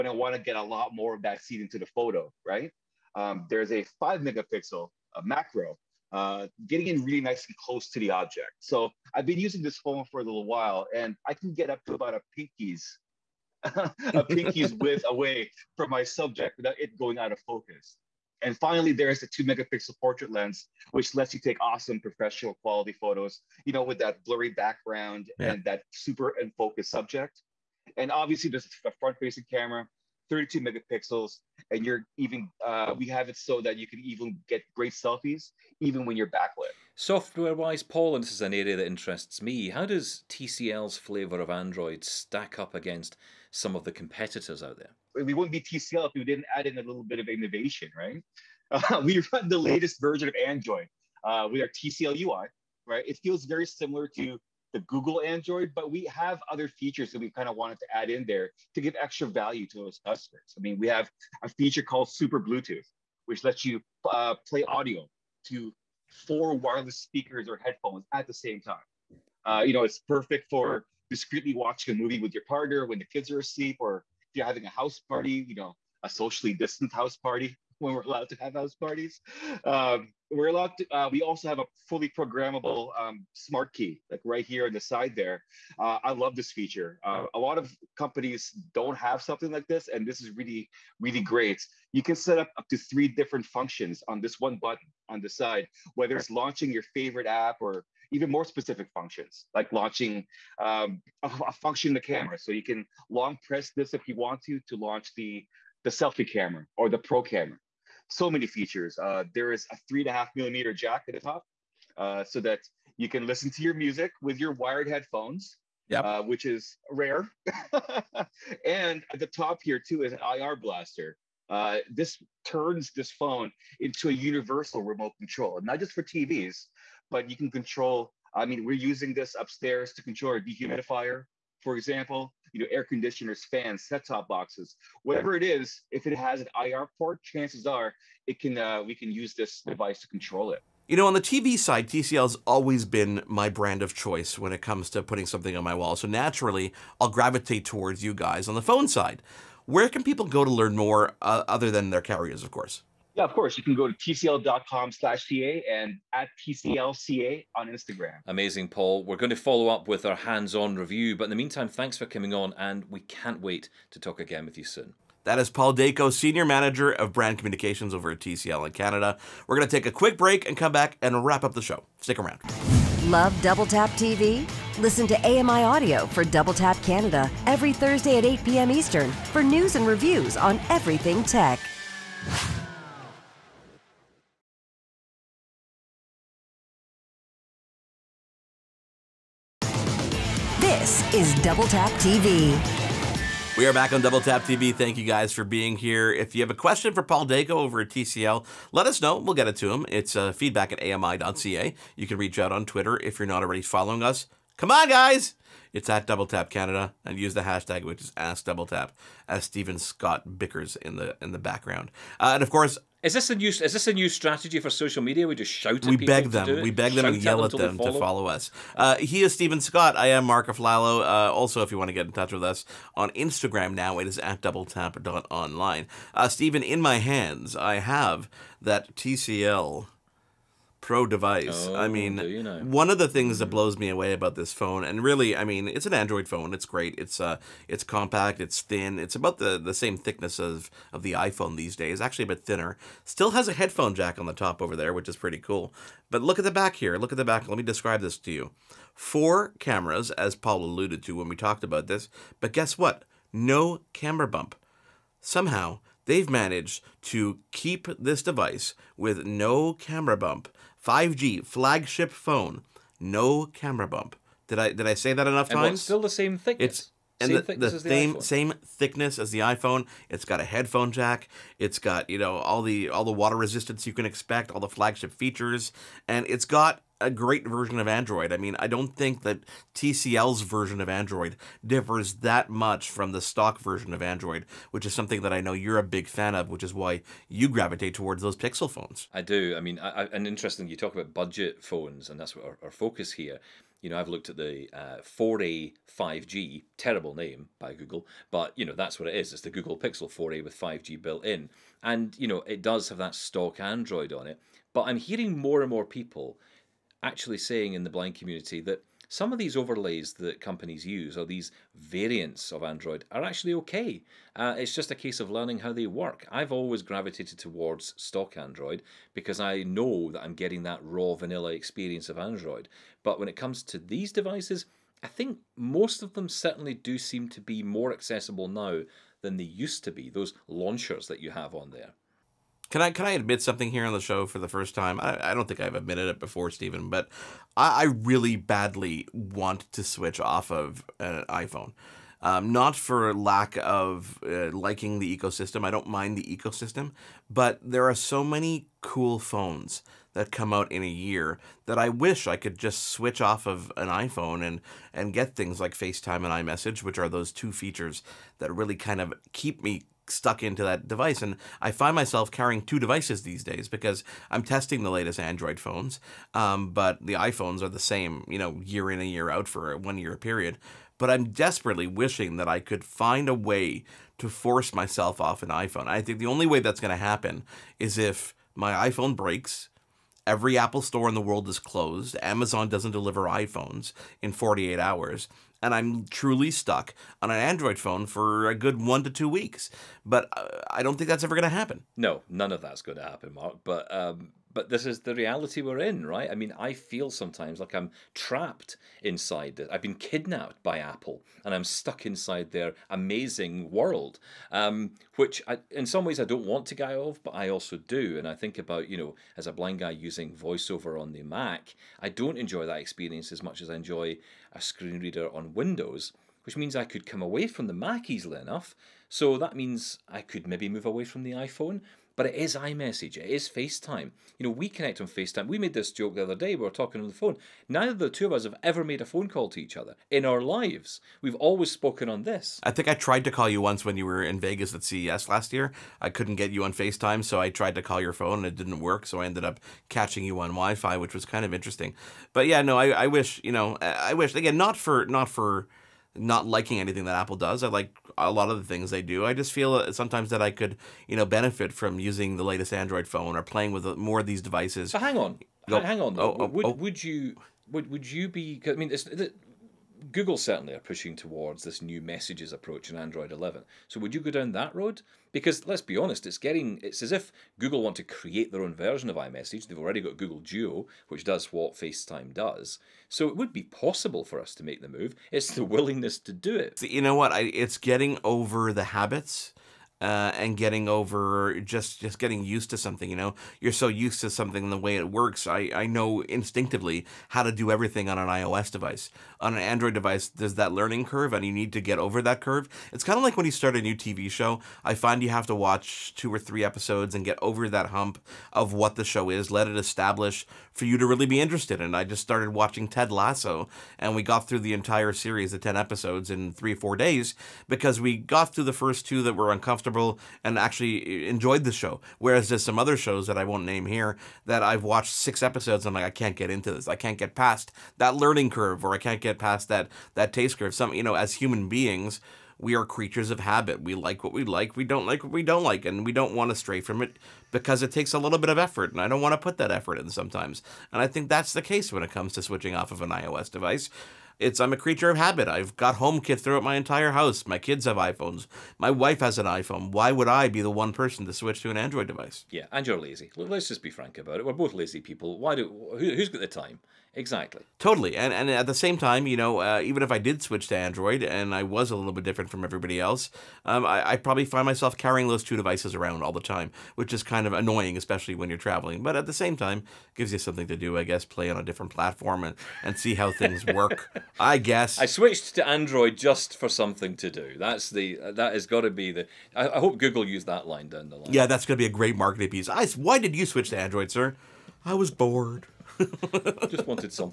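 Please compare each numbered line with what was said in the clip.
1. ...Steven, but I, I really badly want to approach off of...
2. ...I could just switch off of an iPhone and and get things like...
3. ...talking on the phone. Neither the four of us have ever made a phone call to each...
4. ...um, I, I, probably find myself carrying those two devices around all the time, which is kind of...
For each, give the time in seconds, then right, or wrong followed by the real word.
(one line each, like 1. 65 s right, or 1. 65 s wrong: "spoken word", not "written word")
1. 336 s wrong: "switch", not "approach"
2. 352 s right
3. 426 s wrong: "two", not "four"
4. 553 s right.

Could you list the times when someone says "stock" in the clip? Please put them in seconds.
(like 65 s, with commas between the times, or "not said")
283 s, 303 s, 317 s.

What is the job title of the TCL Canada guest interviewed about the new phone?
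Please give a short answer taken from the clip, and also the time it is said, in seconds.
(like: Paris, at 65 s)
Senior Manager of Brand Communications, at 166 s.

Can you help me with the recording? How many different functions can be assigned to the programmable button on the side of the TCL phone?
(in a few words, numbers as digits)
3.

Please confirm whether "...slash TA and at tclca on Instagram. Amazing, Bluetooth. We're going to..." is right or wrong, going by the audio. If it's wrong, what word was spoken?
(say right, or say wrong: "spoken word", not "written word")
wrong: "Paul", not "Bluetooth".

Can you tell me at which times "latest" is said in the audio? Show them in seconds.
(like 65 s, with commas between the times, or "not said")
49 s, 364 s, 452 s.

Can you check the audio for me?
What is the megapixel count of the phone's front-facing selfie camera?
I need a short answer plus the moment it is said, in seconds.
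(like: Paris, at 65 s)
32, at 30 s.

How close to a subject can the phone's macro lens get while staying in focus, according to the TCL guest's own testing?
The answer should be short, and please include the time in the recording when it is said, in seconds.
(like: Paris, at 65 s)
a pinky's width, at 14 s.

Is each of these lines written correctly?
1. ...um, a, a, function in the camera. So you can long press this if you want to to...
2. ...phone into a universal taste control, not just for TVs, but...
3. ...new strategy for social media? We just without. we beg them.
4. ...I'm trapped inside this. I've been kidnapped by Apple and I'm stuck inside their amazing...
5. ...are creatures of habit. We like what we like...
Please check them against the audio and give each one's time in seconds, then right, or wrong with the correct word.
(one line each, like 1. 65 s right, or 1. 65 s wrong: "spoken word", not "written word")
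1. 100 s right
2. 123 s wrong: "remote", not "taste"
3. 213 s wrong: "shout", not "without"
4. 397 s right
5. 522 s right.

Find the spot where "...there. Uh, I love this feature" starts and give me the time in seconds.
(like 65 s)
85 s.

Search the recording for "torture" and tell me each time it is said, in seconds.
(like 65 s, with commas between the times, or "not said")
not said.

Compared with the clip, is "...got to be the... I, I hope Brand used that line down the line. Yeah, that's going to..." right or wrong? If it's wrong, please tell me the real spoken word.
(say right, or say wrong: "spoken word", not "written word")
wrong: "Google", not "Brand".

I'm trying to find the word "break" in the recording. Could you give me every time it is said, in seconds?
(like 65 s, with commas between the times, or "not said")
170 s, 379 s.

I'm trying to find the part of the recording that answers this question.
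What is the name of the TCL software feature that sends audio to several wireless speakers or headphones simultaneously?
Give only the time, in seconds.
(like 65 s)
62 s.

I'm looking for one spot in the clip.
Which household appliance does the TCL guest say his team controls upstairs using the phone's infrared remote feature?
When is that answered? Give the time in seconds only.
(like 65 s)
130 s.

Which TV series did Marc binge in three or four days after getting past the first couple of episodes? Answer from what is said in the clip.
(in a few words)
Ted Lasso.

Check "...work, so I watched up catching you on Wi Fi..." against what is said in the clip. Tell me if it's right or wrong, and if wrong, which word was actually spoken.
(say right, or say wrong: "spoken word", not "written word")
wrong: "ended", not "watched".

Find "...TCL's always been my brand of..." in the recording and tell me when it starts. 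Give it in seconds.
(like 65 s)
141 s.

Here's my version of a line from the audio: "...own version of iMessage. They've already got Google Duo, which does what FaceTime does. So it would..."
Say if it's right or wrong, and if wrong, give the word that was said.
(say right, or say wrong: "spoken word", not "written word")
right.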